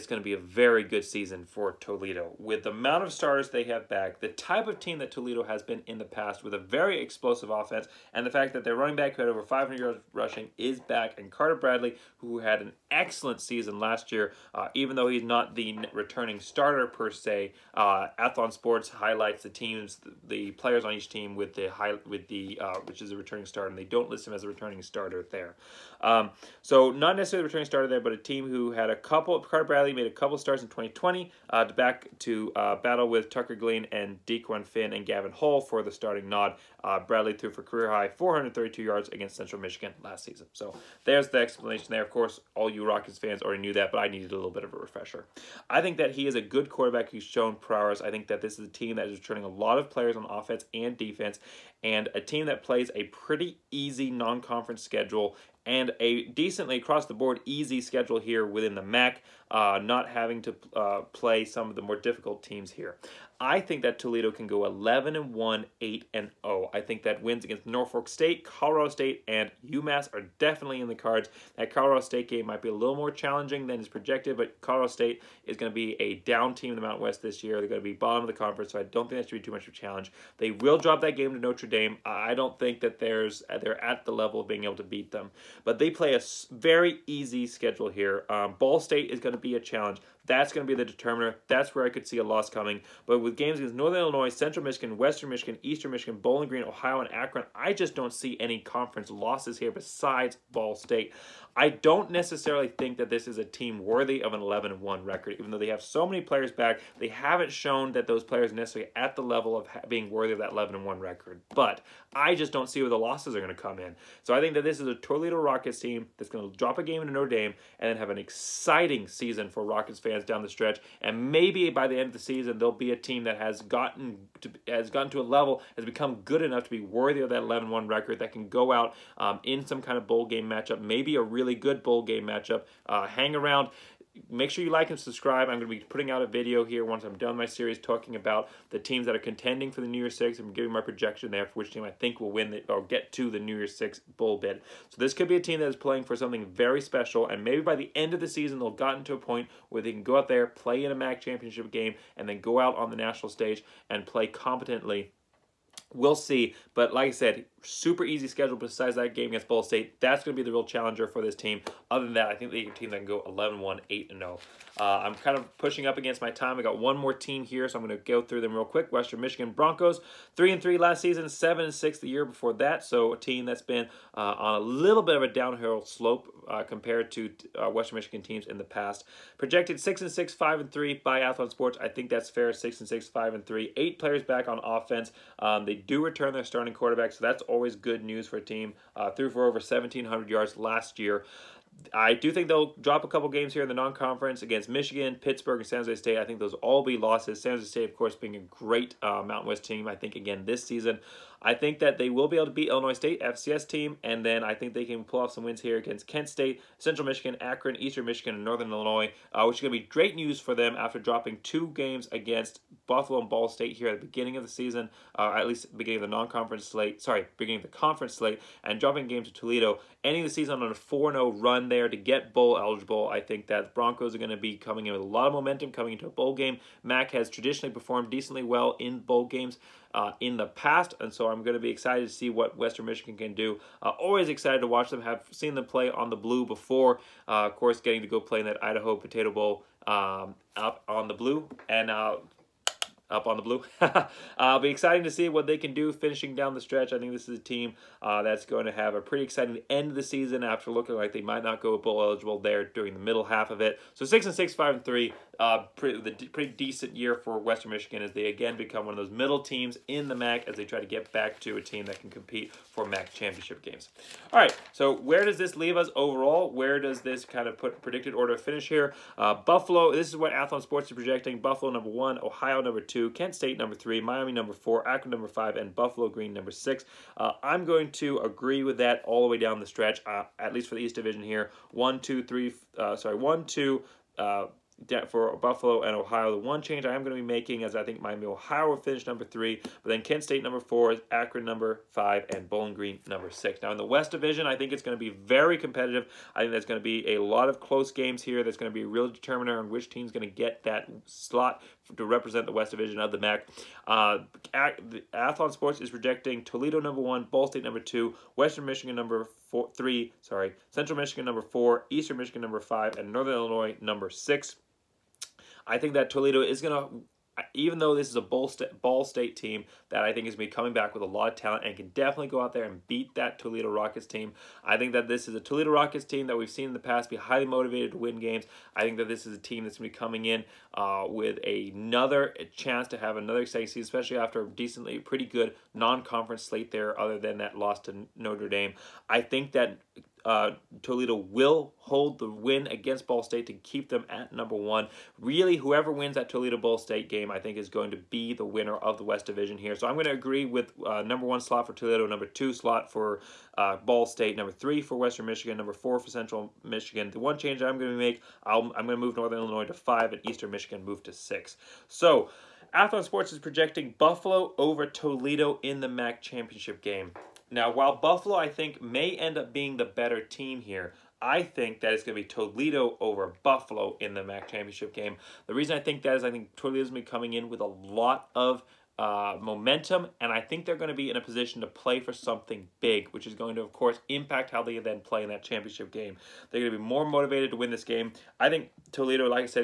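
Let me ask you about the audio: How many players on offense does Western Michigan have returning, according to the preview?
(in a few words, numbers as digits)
8.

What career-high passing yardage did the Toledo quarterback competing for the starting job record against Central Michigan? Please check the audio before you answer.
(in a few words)
432.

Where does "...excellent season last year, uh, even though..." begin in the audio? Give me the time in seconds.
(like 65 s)
12 s.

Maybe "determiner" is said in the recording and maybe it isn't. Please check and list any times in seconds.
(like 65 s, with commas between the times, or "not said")
90 s, 299 s.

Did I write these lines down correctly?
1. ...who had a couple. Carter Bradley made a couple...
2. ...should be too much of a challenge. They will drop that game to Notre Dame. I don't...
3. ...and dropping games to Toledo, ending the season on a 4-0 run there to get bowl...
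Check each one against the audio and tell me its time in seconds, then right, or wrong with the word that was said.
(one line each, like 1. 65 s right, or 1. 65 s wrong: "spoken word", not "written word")
1. 28 s right
2. 79 s right
3. 218 s right.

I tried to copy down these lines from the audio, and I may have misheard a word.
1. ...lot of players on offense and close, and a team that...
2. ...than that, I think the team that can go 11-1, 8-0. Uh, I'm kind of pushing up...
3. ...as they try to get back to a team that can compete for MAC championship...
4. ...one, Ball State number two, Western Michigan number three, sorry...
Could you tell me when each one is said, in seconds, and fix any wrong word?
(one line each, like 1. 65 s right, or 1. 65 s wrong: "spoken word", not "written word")
1. 49 s wrong: "defense", not "close"
2. 162 s right
3. 260 s right
4. 307 s right.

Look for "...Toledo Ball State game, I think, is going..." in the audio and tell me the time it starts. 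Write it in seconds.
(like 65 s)
346 s.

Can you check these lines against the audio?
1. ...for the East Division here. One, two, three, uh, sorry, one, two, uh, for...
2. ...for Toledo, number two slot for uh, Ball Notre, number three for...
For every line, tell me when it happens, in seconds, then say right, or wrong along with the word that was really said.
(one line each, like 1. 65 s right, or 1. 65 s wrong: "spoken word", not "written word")
1. 280 s right
2. 351 s wrong: "State", not "Notre".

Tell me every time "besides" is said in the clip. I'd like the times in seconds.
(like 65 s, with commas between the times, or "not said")
99 s, 158 s.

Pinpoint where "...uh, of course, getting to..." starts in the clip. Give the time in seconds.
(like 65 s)
237 s.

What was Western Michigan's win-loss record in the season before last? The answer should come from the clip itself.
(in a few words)
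7-6.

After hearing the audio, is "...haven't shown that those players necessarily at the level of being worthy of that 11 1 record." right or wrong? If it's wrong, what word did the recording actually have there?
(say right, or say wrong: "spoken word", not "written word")
right.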